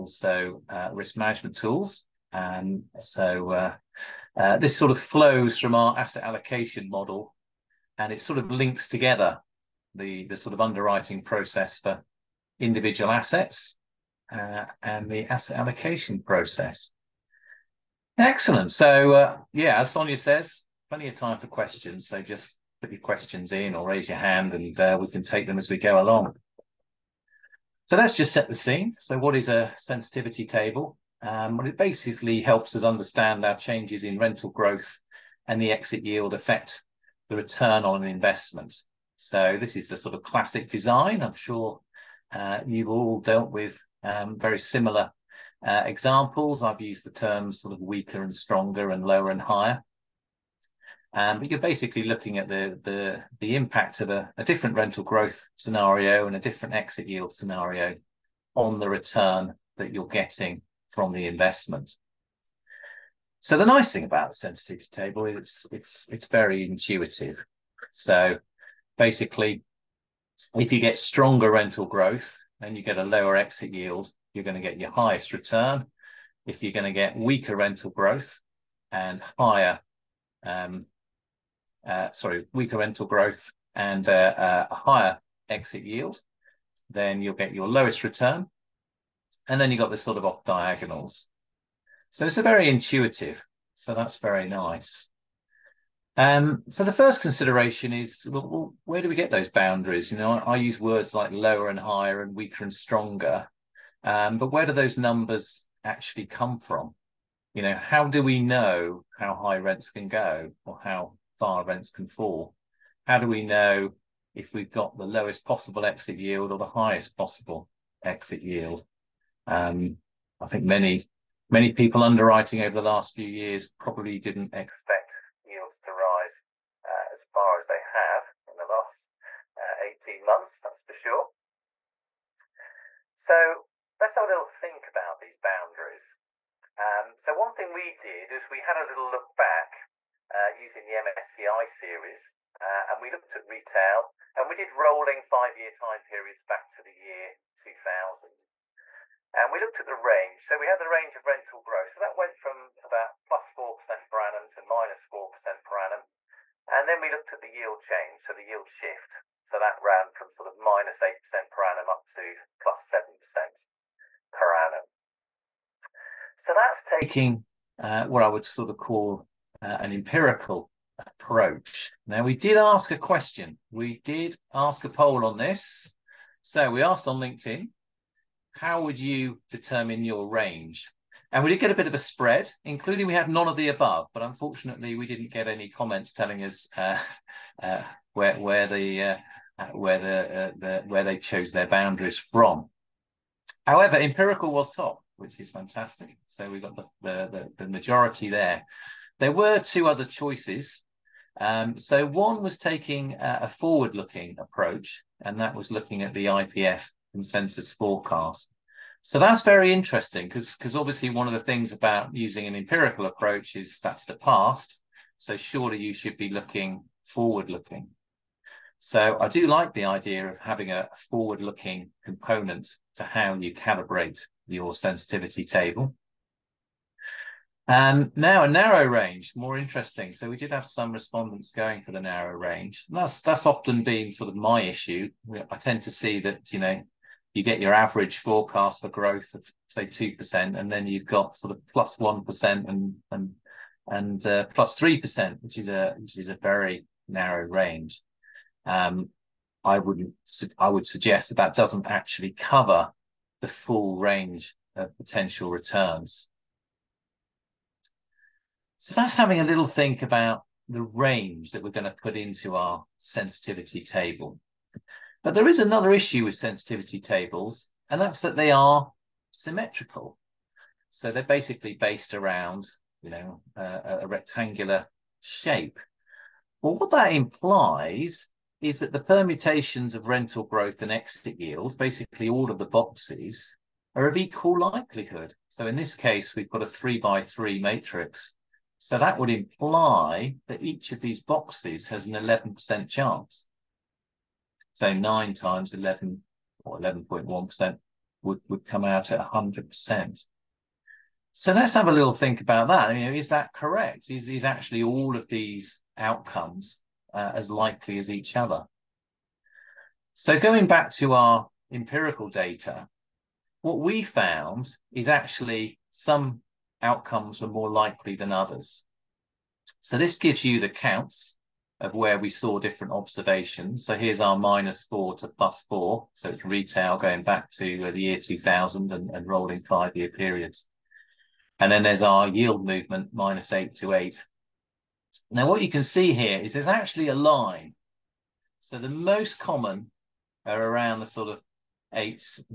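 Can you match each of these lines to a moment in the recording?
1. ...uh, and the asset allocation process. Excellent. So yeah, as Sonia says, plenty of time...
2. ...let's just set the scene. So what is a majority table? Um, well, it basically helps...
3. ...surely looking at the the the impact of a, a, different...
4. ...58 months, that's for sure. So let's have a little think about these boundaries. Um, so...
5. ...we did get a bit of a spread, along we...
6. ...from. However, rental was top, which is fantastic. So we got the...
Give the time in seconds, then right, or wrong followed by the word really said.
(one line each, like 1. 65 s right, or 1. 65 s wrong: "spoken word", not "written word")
1. 14 s right
2. 27 s wrong: "sensitivity", not "majority"
3. 51 s wrong: "basically", not "surely"
4. 129 s wrong: "18", not "58"
5. 181 s wrong: "including", not "along"
6. 192 s wrong: "empirical", not "rental".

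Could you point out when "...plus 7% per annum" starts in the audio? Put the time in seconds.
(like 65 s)
162 s.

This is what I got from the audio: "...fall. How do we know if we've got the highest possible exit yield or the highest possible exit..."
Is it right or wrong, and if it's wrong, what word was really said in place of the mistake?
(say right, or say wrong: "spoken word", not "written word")
wrong: "lowest", not "highest".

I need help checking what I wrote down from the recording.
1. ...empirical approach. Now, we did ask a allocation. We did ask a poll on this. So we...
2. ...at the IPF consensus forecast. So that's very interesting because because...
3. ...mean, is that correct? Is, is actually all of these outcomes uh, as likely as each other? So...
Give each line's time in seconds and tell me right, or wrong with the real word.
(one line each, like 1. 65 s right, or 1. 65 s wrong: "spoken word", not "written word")
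1. 169 s wrong: "question", not "allocation"
2. 206 s right
3. 302 s right.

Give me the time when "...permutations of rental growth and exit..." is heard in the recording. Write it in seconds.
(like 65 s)
278 s.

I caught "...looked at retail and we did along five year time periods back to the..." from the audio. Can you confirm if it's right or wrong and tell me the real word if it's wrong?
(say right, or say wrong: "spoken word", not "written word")
wrong: "rolling", not "along".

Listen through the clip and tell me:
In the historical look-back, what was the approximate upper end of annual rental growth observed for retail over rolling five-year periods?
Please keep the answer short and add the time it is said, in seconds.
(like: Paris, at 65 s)
plus 4% per annum, at 153 s.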